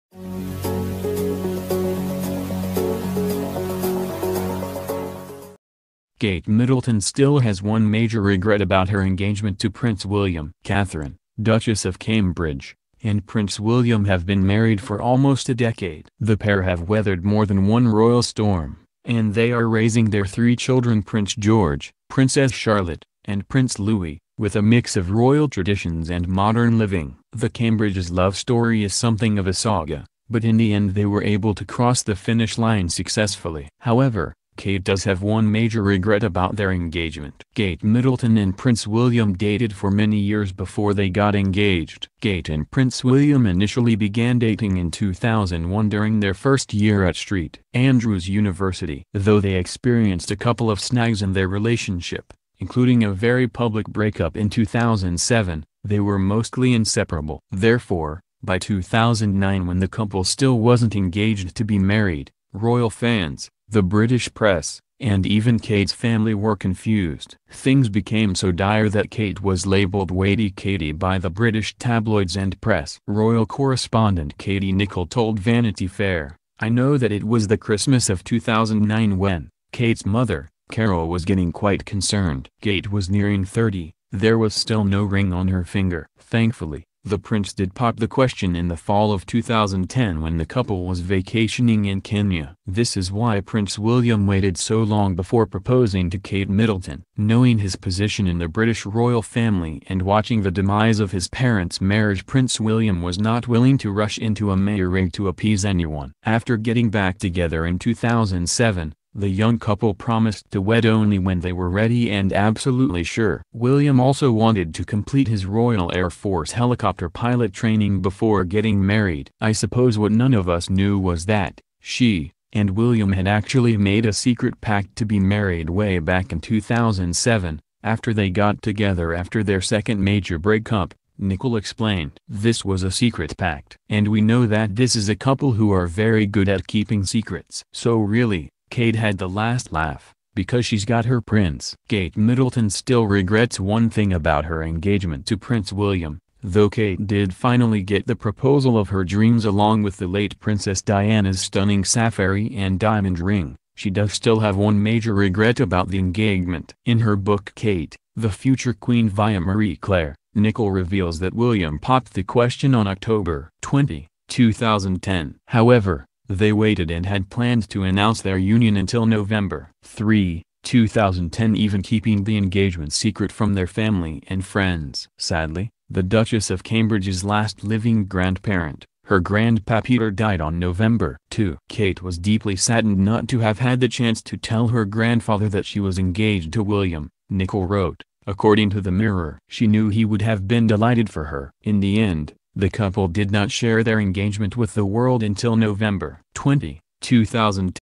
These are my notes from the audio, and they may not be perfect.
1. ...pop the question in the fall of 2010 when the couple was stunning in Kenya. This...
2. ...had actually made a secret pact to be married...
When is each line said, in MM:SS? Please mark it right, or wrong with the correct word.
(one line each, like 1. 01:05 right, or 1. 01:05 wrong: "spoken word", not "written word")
1. 01:27 wrong: "vacationing", not "stunning"
2. 02:03 right.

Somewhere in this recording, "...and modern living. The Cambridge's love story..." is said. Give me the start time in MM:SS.
00:26.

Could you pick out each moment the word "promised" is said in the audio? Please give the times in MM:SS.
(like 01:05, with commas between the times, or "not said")
01:49.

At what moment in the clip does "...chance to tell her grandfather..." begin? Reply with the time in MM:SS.
03:03.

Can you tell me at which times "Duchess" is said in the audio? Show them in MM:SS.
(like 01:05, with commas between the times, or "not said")
00:11, 02:56.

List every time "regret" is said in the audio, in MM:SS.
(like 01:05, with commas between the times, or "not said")
00:08, 00:35, 02:23, 02:35.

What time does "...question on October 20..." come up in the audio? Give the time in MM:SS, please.
02:42.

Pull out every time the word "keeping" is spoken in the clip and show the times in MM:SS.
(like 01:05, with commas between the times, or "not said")
02:16, 02:51.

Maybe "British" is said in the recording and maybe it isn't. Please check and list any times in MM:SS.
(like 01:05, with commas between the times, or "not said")
01:03, 01:11, 01:38.